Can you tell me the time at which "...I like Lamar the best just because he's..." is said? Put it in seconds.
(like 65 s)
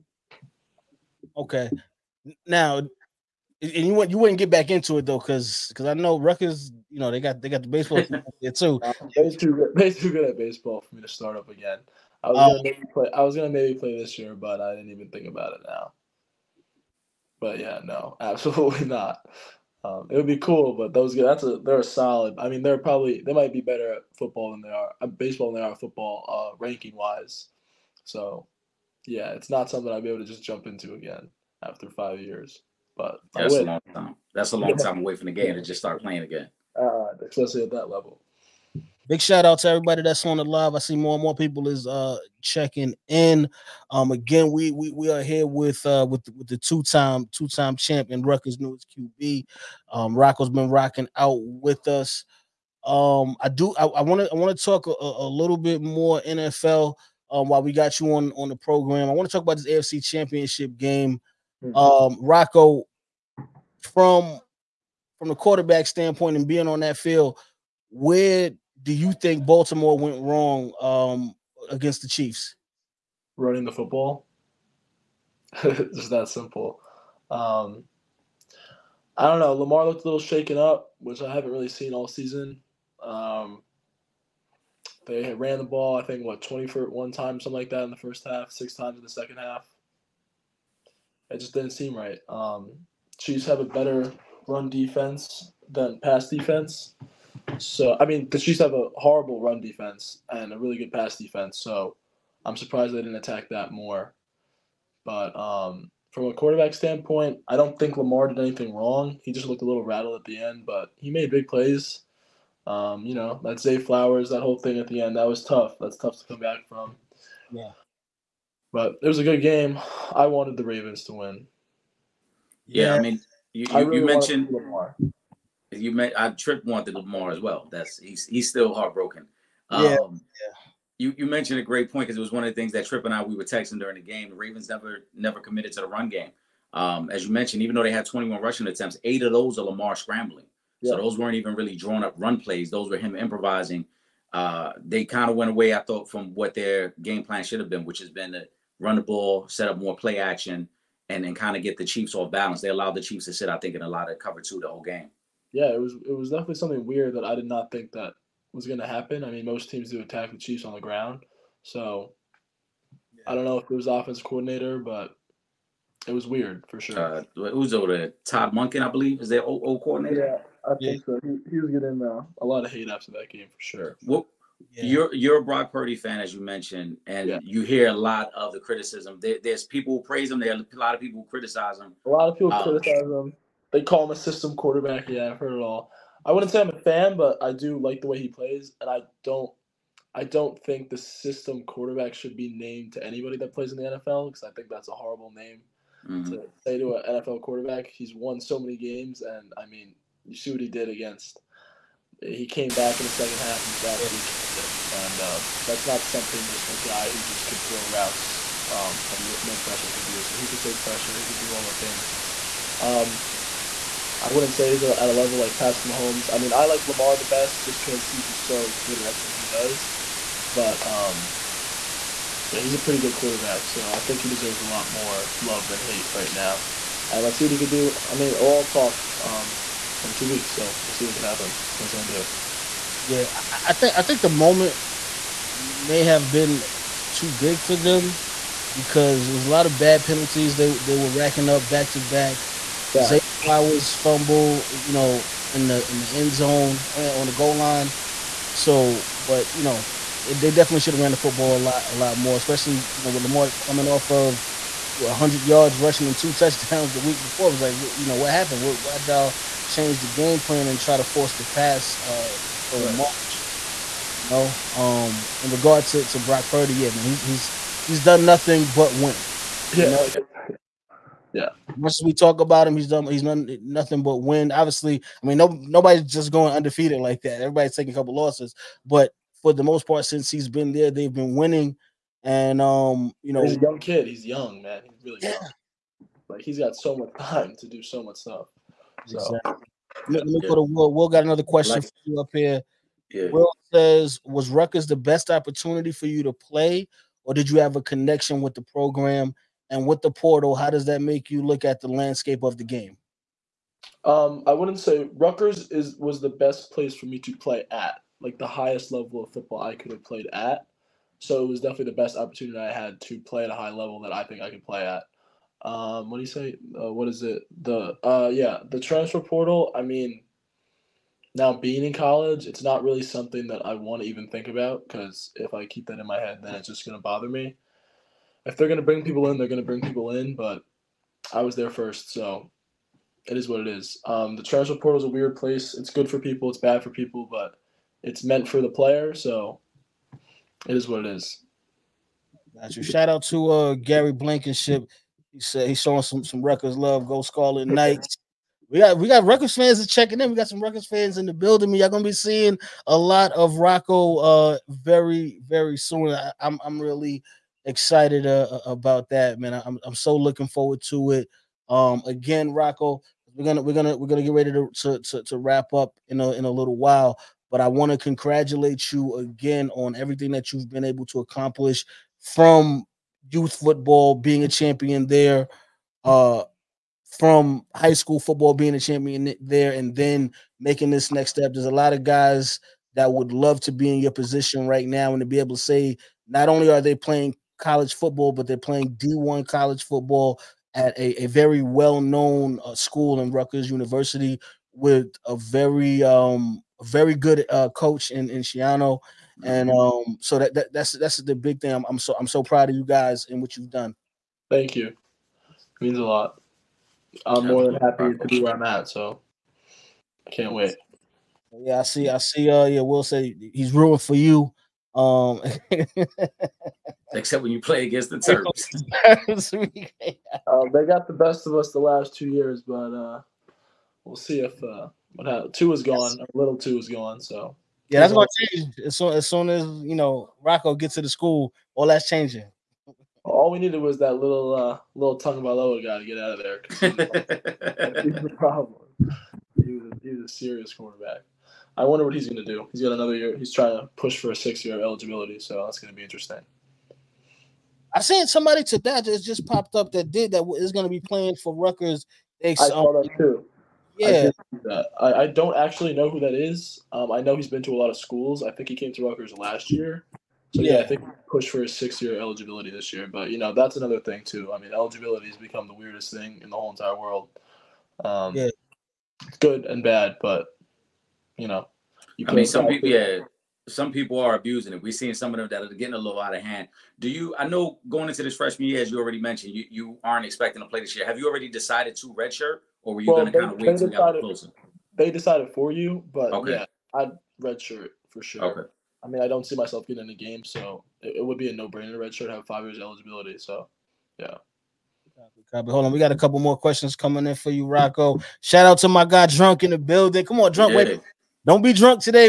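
216 s.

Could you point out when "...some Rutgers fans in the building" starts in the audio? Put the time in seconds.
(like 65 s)
350 s.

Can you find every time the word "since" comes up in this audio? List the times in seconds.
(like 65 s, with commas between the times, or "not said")
280 s.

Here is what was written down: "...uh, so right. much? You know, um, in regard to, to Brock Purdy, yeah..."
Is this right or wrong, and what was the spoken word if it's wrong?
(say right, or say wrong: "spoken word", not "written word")
right.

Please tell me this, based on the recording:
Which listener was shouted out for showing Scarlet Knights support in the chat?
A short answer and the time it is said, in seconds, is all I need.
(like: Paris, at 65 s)
Gary Blankenship, at 343 s.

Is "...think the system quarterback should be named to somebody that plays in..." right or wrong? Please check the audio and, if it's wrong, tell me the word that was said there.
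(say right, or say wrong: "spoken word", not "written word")
wrong: "anybody", not "somebody".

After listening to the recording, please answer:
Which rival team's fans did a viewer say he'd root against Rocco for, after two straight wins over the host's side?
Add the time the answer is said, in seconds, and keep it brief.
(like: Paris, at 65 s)
Terps, at 418 s.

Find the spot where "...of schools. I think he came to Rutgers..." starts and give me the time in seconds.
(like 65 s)
457 s.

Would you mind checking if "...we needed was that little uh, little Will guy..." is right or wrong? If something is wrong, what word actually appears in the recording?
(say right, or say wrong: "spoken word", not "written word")
wrong: "Tagovailoa", not "Will".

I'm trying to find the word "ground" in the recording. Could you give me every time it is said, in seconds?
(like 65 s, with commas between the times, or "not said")
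160 s.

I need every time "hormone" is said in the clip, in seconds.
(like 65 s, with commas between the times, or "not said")
not said.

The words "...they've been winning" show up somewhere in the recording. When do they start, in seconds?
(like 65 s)
280 s.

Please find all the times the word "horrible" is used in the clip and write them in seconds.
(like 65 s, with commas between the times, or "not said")
98 s, 194 s.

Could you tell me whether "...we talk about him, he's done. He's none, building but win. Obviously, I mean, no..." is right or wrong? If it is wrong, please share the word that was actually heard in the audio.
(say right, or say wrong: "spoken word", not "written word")
wrong: "nothing", not "building".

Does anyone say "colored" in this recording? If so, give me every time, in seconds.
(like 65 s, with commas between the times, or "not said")
not said.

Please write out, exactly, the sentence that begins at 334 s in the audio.
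Um, the transfer portal is a weird place.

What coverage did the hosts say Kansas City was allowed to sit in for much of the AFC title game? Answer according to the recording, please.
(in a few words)
Cover two.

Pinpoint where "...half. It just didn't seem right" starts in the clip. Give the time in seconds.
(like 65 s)
89 s.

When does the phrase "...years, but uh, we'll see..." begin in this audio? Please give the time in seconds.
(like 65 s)
422 s.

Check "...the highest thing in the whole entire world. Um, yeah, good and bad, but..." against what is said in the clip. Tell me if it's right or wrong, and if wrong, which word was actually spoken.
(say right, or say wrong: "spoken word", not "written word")
wrong: "weirdest", not "highest".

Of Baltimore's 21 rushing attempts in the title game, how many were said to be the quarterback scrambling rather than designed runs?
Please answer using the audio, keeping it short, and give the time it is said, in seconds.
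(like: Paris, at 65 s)
8, at 139 s.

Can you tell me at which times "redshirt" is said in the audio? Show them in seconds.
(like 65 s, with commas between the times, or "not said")
482 s, 487 s, 491 s.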